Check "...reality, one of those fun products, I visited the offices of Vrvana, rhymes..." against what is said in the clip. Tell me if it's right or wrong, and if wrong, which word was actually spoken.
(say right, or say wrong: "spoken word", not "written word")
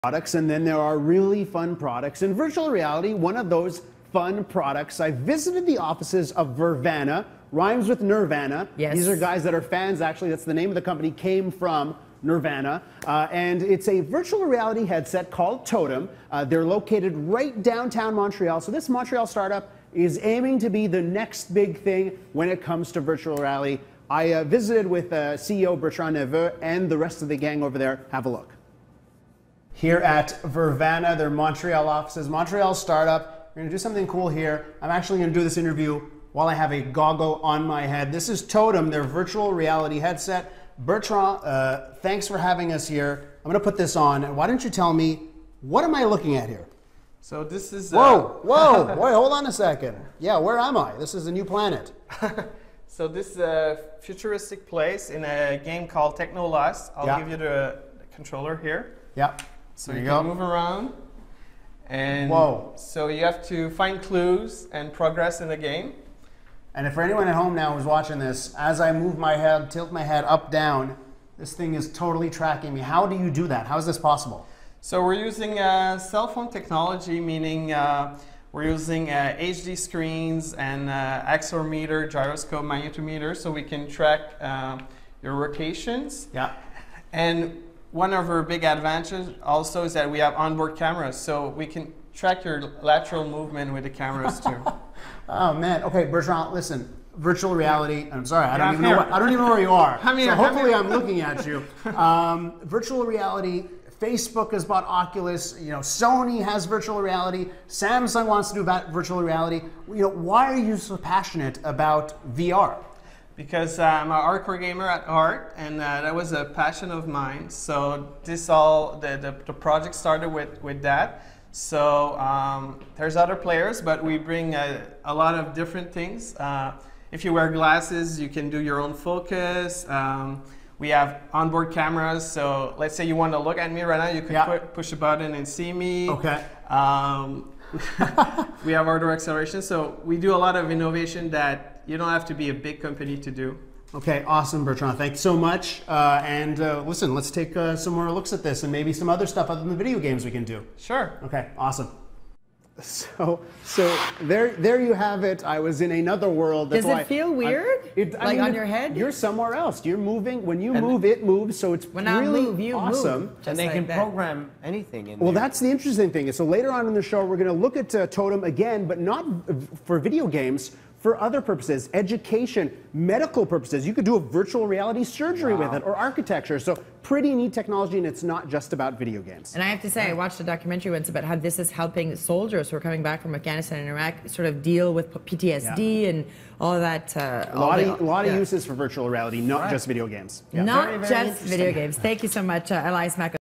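right.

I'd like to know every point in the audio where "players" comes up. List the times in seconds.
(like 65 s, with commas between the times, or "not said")
123 s.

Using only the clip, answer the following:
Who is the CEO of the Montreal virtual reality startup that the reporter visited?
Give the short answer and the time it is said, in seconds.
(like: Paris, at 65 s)
Bertrand Nepveu, at 25 s.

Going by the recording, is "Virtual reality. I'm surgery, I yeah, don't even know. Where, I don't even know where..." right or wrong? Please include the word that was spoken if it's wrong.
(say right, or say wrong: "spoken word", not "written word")
wrong: "sorry", not "surgery".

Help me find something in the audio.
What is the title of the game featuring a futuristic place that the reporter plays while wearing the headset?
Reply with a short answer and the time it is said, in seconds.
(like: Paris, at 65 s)
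Technolust, at 56 s.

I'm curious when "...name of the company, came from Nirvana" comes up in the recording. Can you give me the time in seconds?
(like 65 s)
10 s.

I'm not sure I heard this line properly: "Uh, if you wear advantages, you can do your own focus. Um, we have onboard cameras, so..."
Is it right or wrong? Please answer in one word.
wrong.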